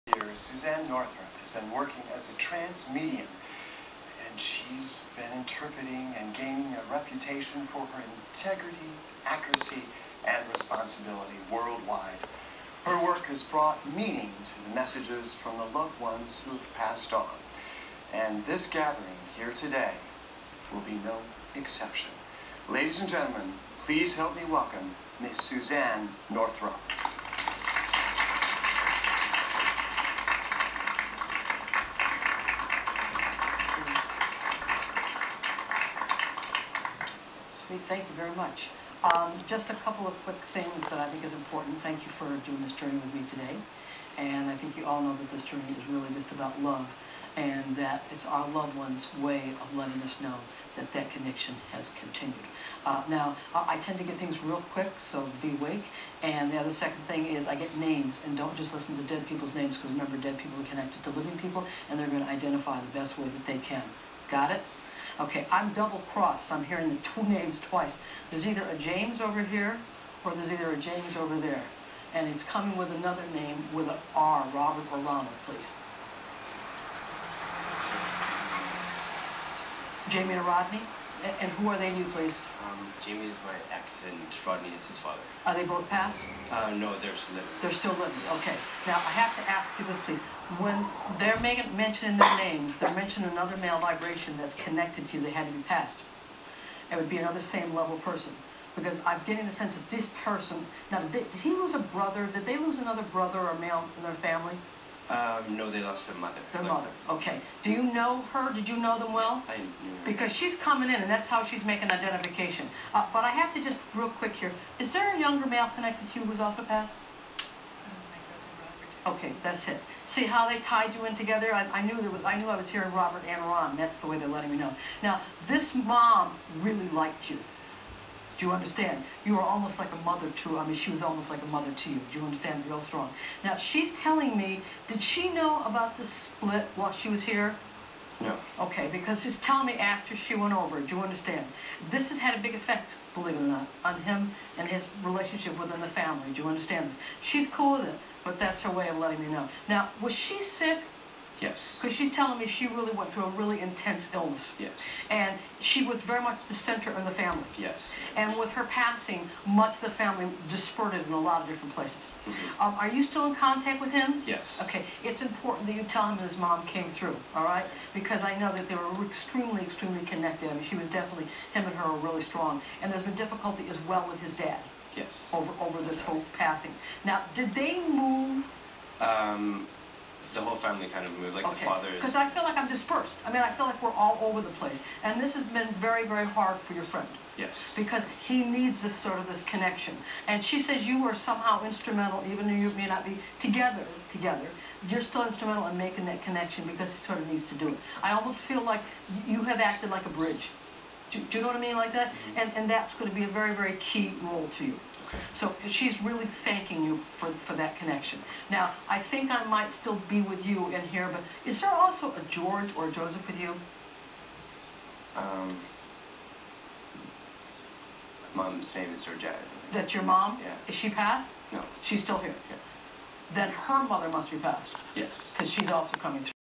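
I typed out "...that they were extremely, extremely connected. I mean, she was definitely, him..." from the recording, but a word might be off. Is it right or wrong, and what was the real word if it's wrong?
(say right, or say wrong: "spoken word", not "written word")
right.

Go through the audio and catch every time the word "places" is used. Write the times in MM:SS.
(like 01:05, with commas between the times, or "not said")
02:41, 03:04.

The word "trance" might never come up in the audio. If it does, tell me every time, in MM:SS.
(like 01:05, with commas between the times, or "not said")
00:02.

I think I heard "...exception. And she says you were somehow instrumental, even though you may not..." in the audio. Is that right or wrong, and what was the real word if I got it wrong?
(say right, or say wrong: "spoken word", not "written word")
wrong: "connection", not "exception".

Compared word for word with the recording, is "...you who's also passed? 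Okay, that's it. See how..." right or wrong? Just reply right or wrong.
right.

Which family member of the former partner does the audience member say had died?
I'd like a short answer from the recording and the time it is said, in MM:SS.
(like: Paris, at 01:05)
Their mother, at 01:45.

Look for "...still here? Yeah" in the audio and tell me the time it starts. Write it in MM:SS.
03:42.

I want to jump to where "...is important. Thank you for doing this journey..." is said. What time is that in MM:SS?
00:41.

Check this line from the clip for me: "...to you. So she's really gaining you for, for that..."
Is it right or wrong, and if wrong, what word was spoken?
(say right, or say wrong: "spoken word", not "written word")
wrong: "thanking", not "gaining".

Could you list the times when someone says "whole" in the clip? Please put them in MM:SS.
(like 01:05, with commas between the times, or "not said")
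02:56, 03:00.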